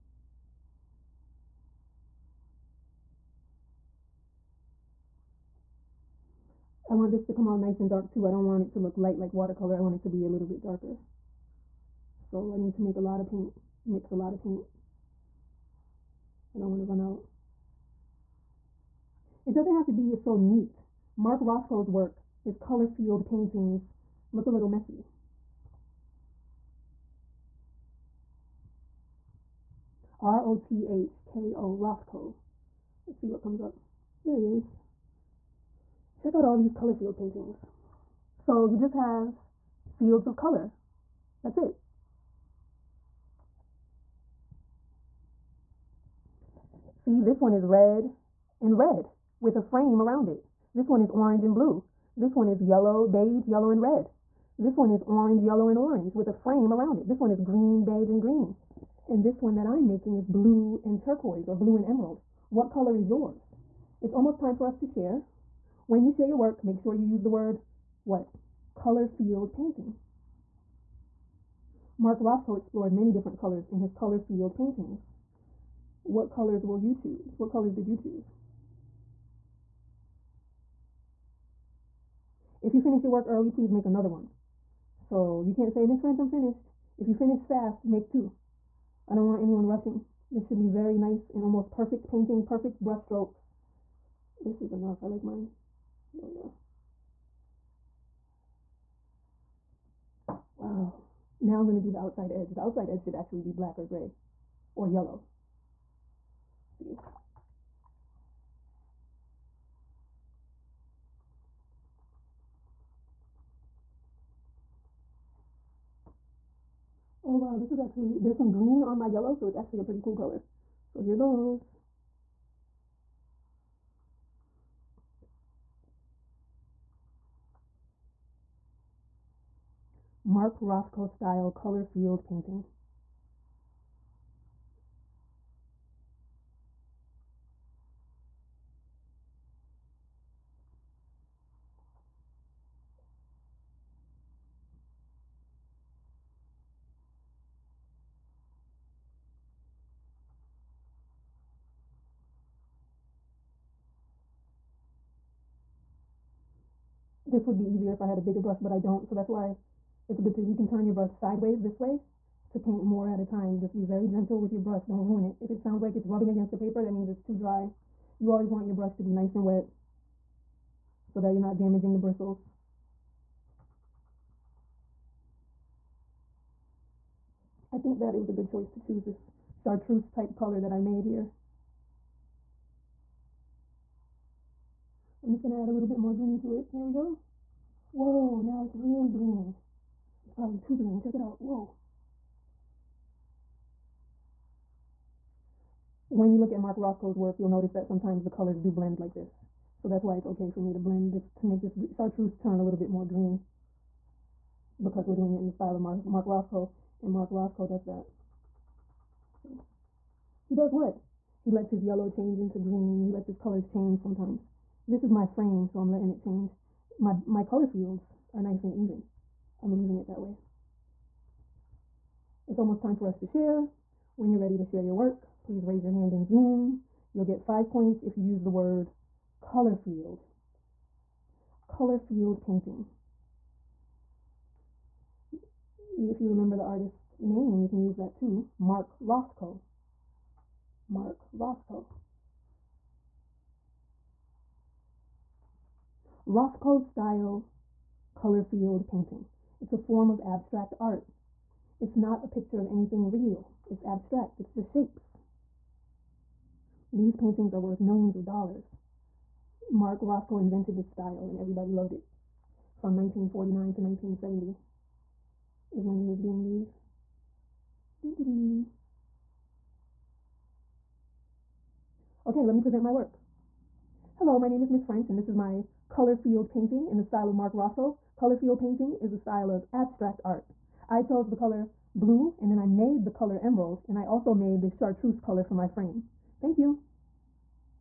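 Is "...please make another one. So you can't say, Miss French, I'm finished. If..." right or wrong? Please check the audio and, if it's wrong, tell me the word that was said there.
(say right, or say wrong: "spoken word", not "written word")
right.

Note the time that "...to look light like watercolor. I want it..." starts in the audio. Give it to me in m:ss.
0:08.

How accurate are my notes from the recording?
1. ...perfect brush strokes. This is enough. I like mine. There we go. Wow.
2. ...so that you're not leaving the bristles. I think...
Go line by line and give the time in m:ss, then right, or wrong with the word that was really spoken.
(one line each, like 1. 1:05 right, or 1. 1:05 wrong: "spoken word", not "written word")
1. 1:32 right
2. 2:51 wrong: "damaging", not "leaving".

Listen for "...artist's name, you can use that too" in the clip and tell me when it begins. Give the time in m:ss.
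3:56.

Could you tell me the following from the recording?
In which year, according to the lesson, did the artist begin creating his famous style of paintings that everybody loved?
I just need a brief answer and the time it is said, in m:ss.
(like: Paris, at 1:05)
1949, at 4:22.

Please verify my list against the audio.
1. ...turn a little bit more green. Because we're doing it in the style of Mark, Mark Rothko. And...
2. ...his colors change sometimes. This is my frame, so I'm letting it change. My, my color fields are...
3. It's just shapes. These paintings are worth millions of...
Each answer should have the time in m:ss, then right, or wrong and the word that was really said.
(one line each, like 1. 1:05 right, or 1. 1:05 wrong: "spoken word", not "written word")
1. 3:22 right
2. 3:33 right
3. 4:14 right.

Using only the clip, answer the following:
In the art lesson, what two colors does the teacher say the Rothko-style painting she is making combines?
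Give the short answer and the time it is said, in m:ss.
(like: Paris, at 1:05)
blue and turquoise, at 1:00.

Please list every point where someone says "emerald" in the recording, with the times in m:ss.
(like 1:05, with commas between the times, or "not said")
1:01, 4:43.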